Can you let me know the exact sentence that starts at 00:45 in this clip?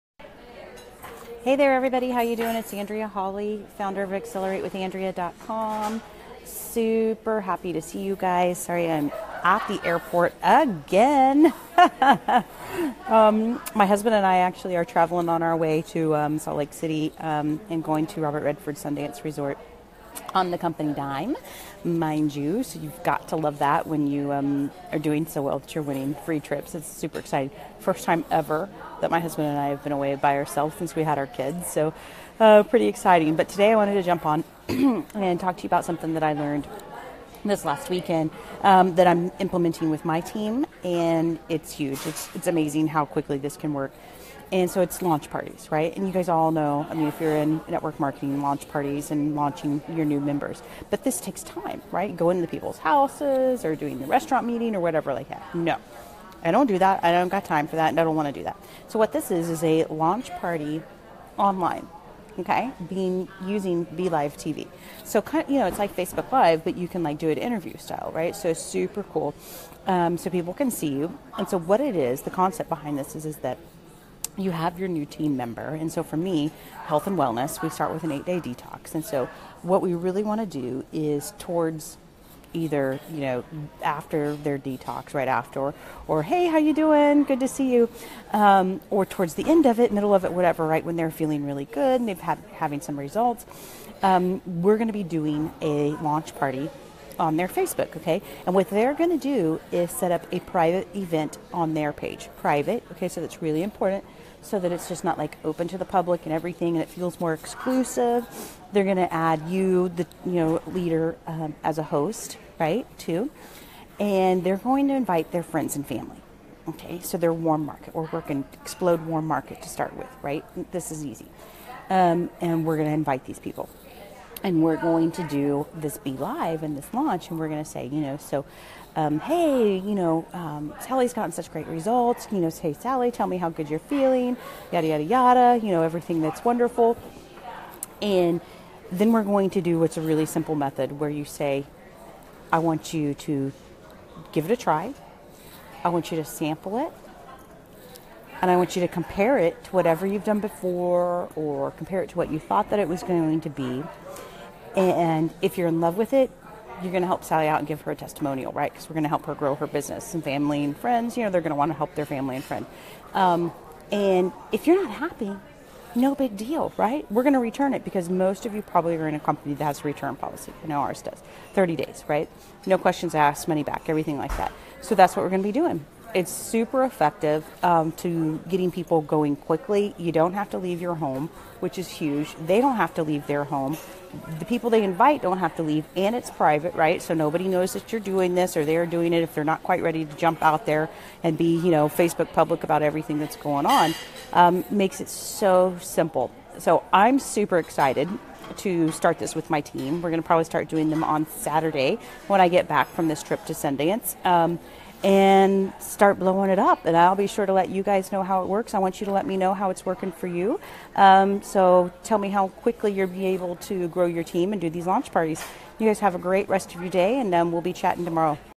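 And you guys all know, I mean, if you're in network marketing, launch parties and launching your new members.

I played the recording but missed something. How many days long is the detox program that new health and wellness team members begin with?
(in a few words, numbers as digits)
8.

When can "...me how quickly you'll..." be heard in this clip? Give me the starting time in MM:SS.
03:32.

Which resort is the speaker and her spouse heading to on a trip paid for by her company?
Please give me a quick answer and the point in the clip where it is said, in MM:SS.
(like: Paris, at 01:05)
Robert Redford Sundance Resort, at 00:18.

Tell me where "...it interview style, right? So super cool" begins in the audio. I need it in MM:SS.
01:07.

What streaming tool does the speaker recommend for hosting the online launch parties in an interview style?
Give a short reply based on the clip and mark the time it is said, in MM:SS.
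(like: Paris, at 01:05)
BeLive TV, at 01:03.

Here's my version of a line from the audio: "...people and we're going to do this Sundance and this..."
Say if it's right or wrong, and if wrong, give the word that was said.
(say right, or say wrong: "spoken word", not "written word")
wrong: "BeLive", not "Sundance".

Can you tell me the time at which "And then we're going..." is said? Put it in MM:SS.
02:18.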